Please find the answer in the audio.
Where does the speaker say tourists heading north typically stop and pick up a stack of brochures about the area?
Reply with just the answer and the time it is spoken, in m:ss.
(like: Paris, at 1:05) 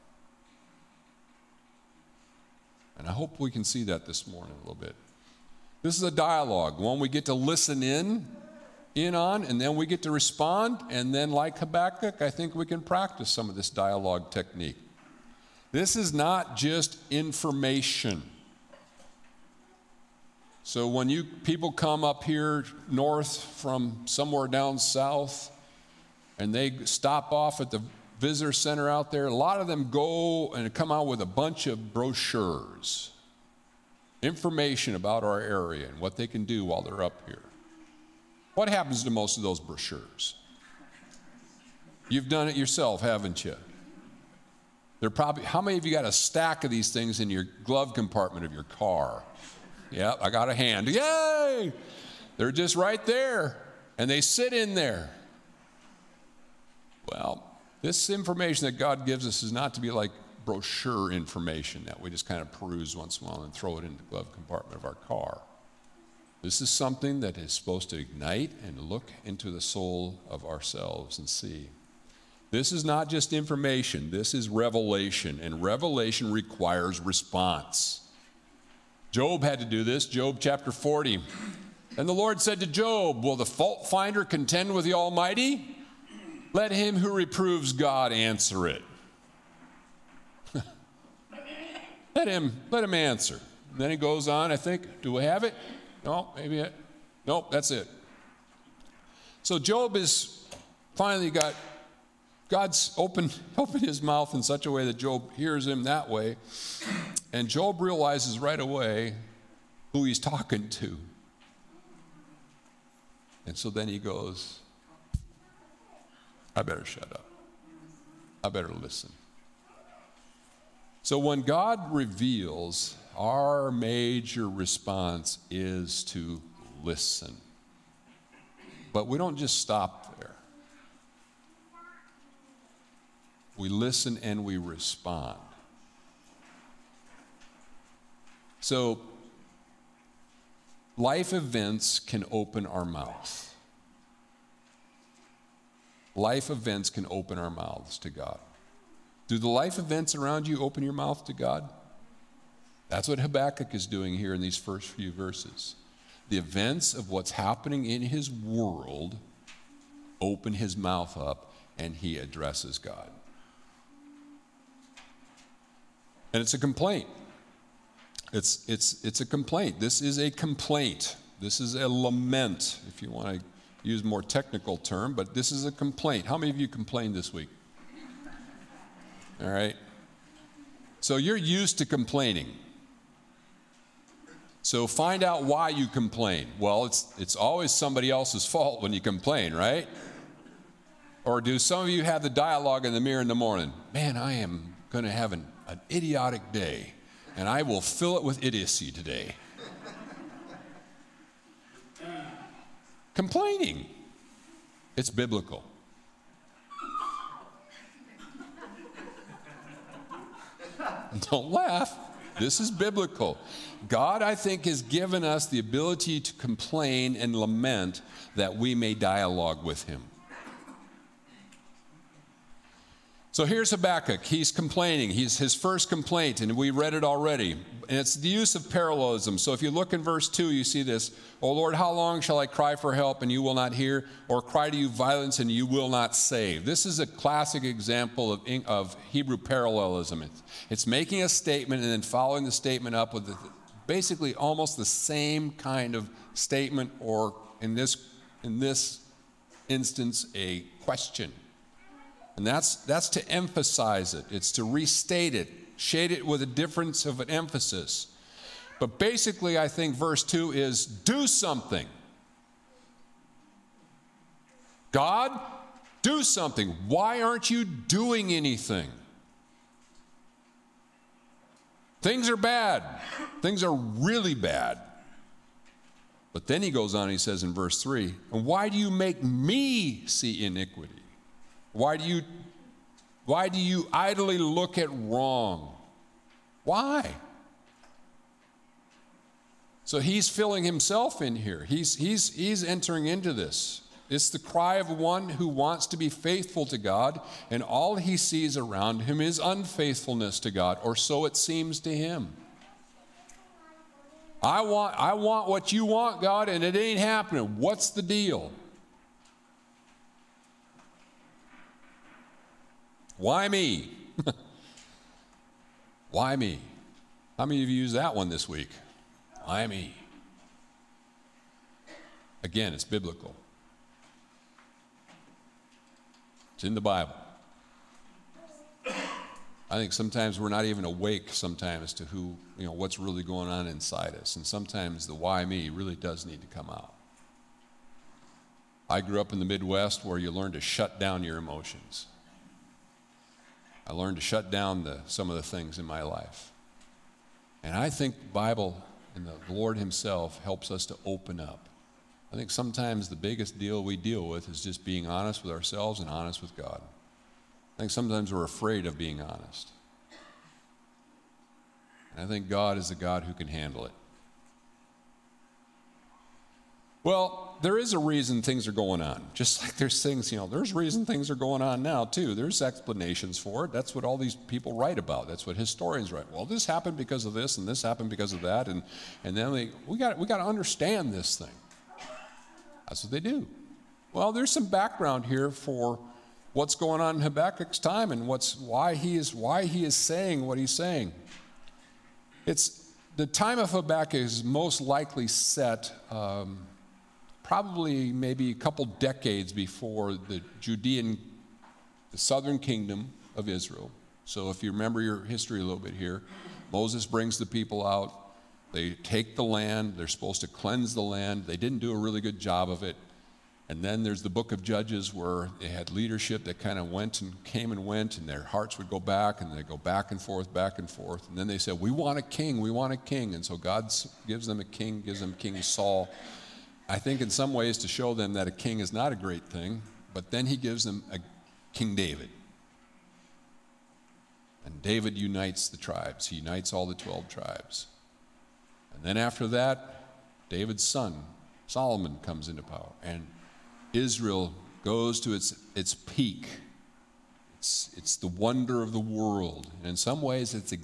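The visitor center, at 0:28.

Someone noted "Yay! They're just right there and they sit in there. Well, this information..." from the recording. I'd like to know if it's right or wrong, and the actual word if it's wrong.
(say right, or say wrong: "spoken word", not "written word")
right.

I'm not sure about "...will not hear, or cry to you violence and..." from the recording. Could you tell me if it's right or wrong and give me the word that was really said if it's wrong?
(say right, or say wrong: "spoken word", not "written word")
right.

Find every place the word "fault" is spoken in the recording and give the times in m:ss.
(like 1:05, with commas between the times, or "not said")
1:23, 3:08.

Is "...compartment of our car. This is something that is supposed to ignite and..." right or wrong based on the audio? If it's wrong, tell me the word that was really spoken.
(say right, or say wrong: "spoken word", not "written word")
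right.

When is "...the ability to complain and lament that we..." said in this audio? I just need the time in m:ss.
3:35.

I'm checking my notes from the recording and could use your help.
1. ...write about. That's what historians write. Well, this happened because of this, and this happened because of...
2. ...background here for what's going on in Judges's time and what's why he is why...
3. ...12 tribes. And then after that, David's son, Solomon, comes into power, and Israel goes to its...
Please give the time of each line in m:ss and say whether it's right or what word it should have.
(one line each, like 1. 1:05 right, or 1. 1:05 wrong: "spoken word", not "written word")
1. 6:14 right
2. 6:24 wrong: "Habakkuk", not "Judges"
3. 7:16 right.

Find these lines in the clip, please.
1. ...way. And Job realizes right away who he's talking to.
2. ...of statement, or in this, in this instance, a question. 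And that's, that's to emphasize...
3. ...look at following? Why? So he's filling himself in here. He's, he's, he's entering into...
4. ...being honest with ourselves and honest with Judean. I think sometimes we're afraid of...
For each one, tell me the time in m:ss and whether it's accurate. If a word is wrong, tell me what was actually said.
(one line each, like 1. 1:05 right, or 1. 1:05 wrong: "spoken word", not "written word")
1. 1:46 right
2. 4:05 right
3. 4:44 wrong: "wrong", not "following"
4. 5:54 wrong: "God", not "Judean".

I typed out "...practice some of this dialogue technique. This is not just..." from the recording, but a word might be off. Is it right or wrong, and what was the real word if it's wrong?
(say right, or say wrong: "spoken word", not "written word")
right.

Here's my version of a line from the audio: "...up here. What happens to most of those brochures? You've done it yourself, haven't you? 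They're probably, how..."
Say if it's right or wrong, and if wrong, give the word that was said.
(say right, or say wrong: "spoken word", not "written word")
right.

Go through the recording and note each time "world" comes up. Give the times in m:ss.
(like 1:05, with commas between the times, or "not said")
2:38, 7:28.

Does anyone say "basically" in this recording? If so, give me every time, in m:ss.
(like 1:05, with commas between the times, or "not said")
4:03, 4:18.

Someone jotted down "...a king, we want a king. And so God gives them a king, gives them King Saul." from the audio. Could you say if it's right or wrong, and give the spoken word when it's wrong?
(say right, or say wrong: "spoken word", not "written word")
right.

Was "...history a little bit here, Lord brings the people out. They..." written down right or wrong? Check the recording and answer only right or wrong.
wrong.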